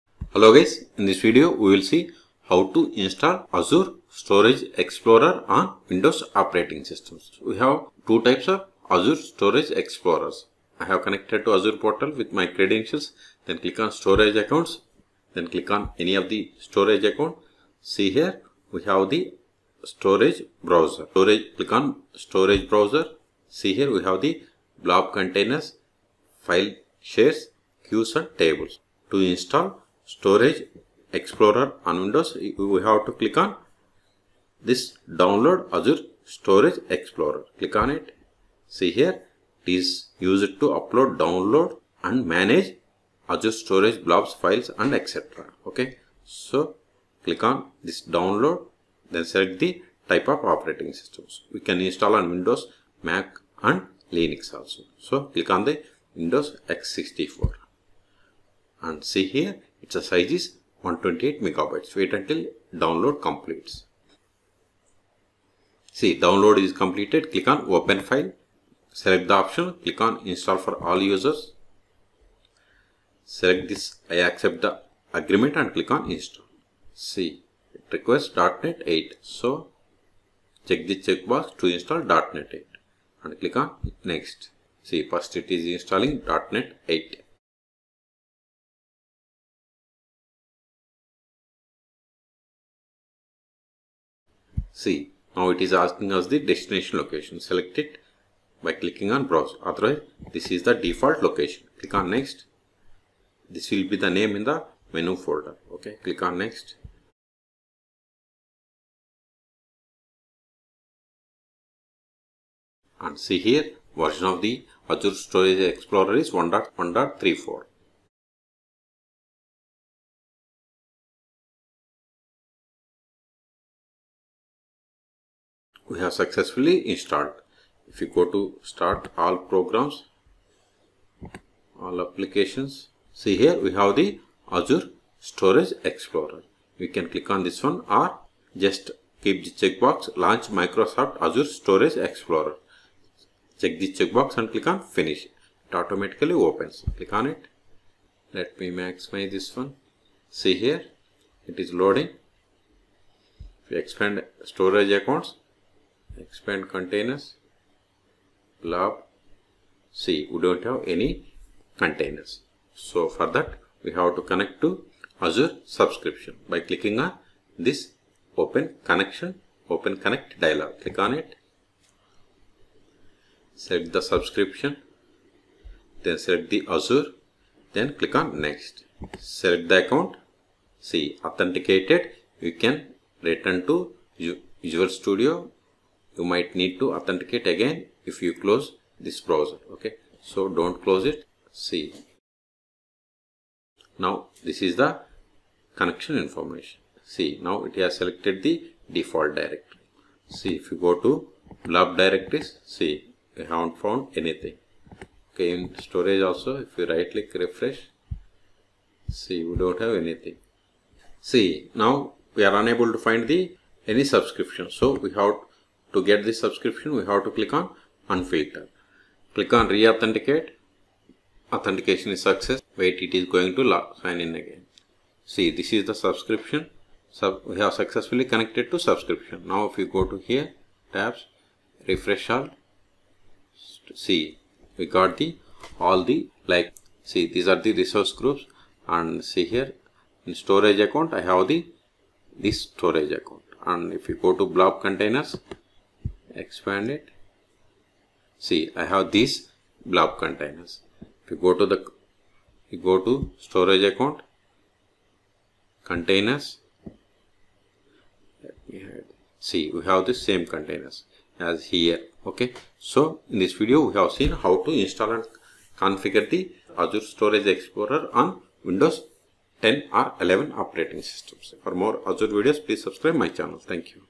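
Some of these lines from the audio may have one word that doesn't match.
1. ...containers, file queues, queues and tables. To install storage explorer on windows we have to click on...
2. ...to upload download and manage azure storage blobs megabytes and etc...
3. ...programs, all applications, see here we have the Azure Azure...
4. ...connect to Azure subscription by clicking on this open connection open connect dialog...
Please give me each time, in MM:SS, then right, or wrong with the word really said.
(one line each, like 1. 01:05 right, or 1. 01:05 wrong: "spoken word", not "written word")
1. 00:25 wrong: "shares", not "queues"
2. 00:40 wrong: "files", not "megabytes"
3. 02:09 wrong: "Storage", not "Azure"
4. 02:44 right.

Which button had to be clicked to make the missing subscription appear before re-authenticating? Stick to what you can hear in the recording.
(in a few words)
unfilter.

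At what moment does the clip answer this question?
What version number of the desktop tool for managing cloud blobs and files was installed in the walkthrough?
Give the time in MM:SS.
01:56.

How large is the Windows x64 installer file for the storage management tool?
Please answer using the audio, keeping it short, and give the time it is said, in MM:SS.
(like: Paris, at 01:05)
128 megabytes, at 01:00.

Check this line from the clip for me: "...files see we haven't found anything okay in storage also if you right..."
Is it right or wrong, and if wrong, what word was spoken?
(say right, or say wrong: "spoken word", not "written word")
wrong: "directories", not "files".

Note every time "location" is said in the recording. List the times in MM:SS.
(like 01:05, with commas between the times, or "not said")
01:36, 01:41.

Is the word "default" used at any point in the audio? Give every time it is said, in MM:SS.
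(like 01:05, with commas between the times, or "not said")
01:40, 03:18.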